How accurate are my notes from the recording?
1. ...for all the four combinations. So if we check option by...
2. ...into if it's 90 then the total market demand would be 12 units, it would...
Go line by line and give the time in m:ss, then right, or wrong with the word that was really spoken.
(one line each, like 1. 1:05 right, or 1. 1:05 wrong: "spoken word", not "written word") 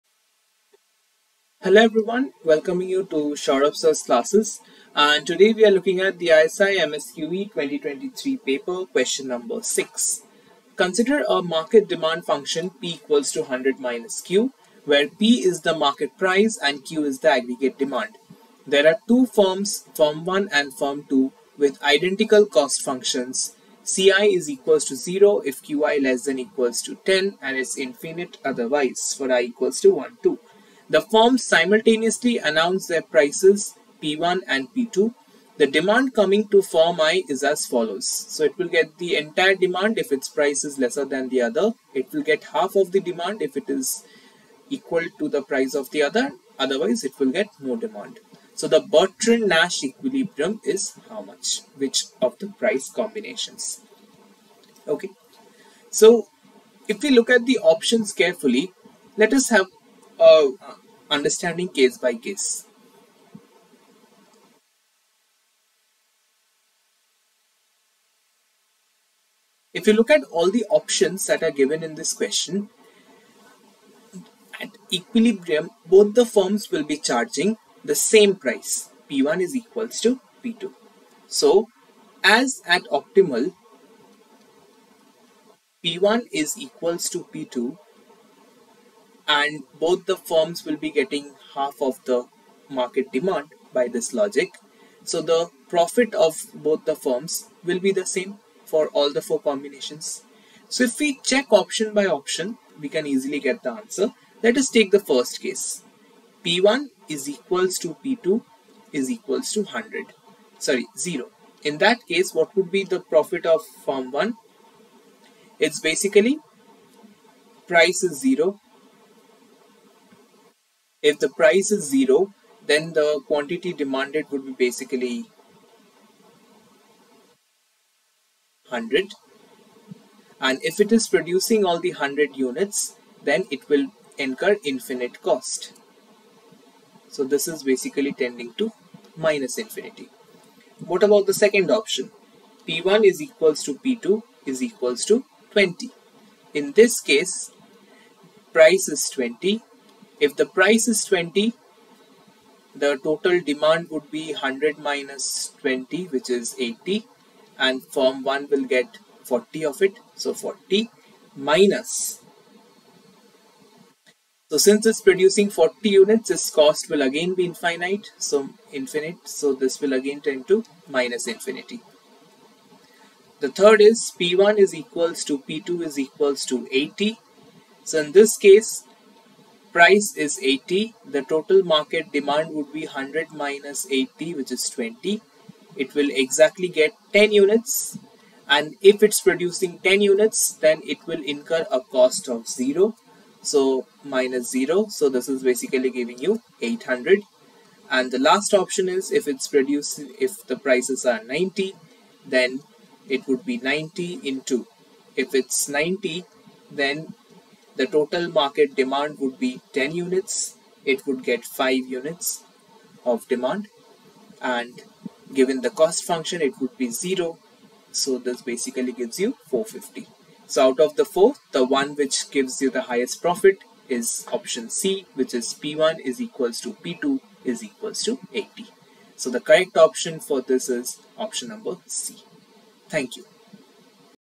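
1. 1:38 right
2. 3:24 wrong: "10", not "12".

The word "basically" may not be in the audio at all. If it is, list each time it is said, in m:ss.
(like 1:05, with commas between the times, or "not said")
1:55, 2:04, 2:17, 3:15, 3:38.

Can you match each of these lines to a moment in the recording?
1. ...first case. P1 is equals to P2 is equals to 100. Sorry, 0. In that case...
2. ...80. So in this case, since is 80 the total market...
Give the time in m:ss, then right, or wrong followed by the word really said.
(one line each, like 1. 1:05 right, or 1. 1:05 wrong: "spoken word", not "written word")
1. 1:44 right
2. 2:56 wrong: "price", not "since".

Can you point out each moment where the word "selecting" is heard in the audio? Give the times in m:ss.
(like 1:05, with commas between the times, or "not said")
not said.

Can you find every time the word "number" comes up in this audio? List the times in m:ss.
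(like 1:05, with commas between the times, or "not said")
0:09, 3:51.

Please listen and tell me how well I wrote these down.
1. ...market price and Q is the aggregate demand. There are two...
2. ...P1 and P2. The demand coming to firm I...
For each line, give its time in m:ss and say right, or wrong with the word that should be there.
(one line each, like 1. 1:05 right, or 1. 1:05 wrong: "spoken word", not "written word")
1. 0:15 right
2. 0:34 right.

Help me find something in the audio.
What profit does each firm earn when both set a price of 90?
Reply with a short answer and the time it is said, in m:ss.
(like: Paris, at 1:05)
450, at 3:39.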